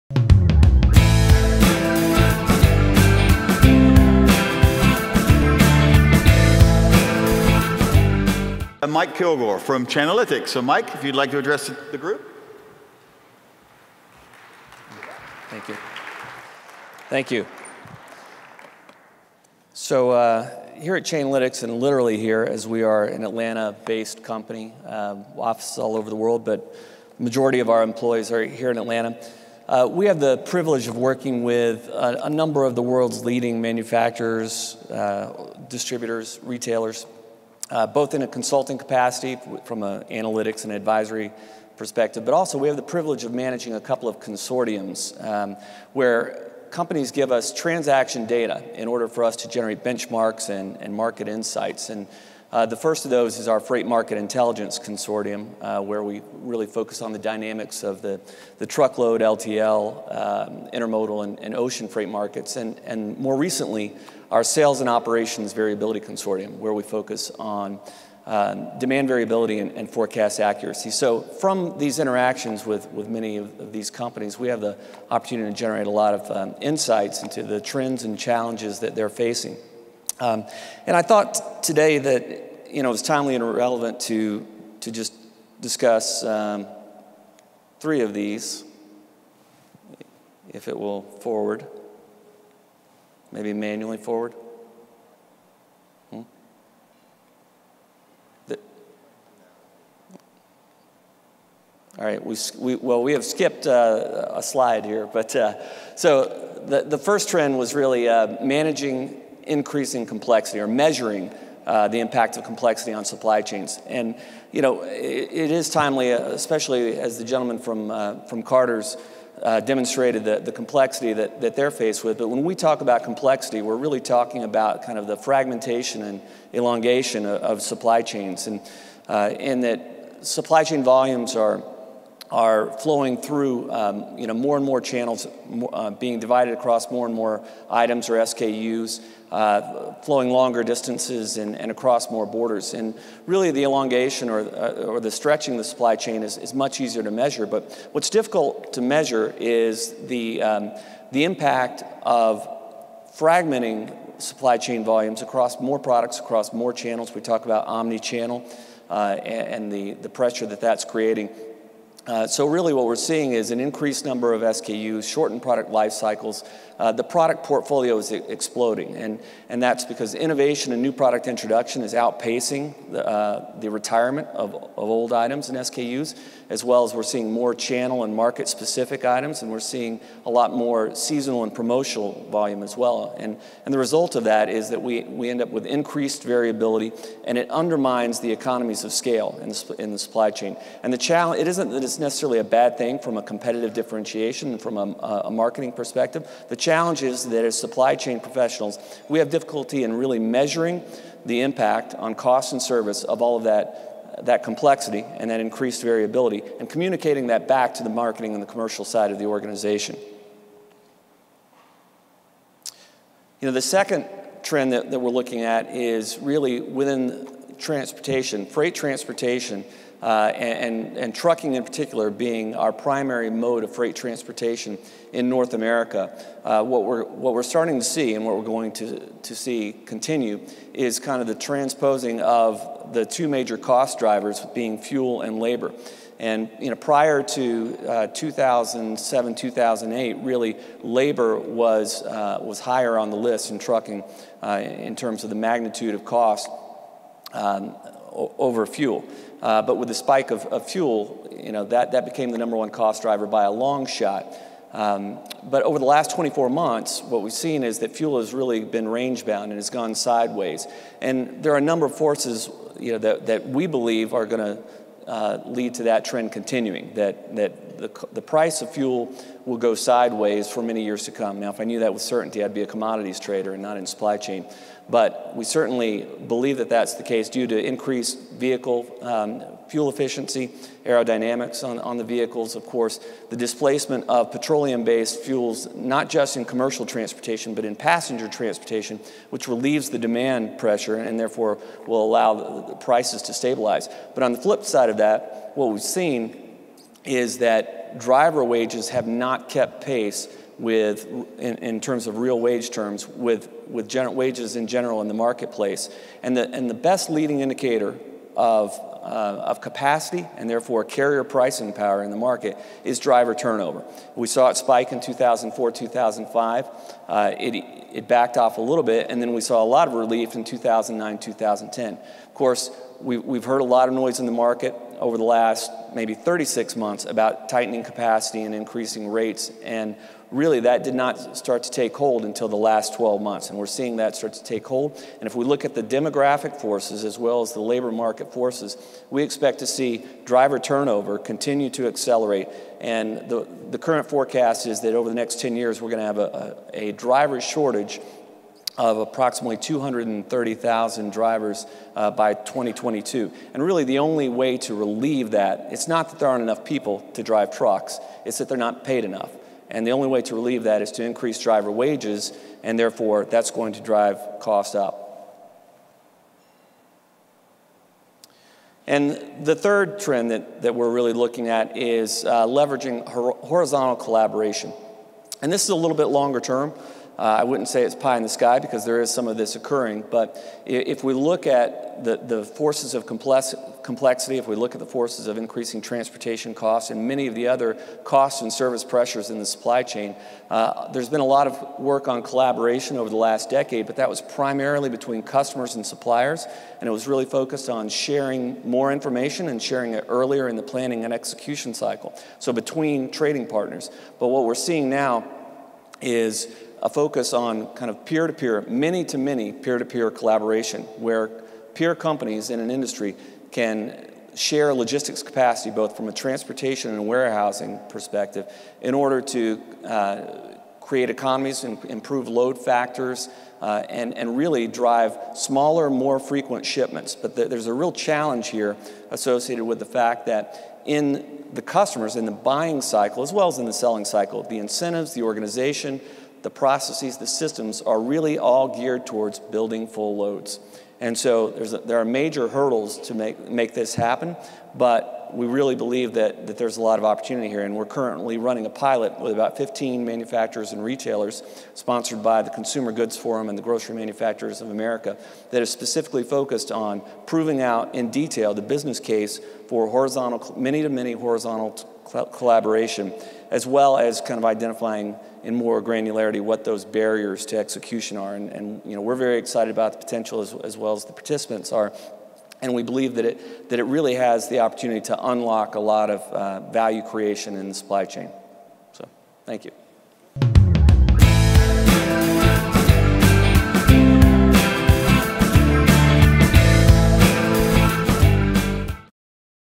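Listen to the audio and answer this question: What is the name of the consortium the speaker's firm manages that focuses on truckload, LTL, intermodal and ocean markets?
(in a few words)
Freight Market Intelligence Consortium.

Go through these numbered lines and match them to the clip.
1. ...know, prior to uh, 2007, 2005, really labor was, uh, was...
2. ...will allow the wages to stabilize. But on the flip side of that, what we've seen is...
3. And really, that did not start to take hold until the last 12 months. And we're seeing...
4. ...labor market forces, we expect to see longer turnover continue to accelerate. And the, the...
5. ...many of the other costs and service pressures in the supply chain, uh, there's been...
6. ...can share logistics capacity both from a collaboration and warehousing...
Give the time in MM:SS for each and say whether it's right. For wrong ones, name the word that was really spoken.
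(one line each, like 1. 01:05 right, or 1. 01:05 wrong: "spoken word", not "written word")
1. 03:56 wrong: "2008", not "2005"
2. 04:51 wrong: "prices", not "wages"
3. 05:29 right
4. 05:37 wrong: "driver", not "longer"
5. 06:27 right
6. 06:53 wrong: "transportation", not "collaboration".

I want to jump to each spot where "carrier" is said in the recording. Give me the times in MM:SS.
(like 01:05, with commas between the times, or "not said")
05:10.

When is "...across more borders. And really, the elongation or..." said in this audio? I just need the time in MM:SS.
02:21.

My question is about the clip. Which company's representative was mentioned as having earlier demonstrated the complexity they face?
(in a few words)
Carter's.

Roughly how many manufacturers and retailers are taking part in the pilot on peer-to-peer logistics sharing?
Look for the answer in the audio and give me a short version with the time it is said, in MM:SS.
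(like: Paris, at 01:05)
About 15, at 07:29.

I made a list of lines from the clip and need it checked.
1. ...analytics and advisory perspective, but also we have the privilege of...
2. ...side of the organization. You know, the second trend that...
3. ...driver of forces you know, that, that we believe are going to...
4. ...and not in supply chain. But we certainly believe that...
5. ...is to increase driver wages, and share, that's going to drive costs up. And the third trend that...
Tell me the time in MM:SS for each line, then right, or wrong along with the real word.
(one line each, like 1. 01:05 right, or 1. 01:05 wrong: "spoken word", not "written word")
1. 00:40 right
2. 03:28 right
3. 04:21 wrong: "number", not "driver"
4. 04:33 right
5. 06:00 wrong: "therefore", not "share".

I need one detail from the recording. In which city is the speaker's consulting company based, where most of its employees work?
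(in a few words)
Atlanta.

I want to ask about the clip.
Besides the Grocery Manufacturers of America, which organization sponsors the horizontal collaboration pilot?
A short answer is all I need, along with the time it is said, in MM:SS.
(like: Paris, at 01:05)
Consumer Goods Forum, at 07:32.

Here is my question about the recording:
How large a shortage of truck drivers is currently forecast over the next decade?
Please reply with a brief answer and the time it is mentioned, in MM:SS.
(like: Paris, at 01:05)
230,000 drivers, at 05:49.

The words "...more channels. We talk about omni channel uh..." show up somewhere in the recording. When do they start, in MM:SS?
02:36.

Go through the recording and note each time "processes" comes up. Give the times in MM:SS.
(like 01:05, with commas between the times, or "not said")
07:16.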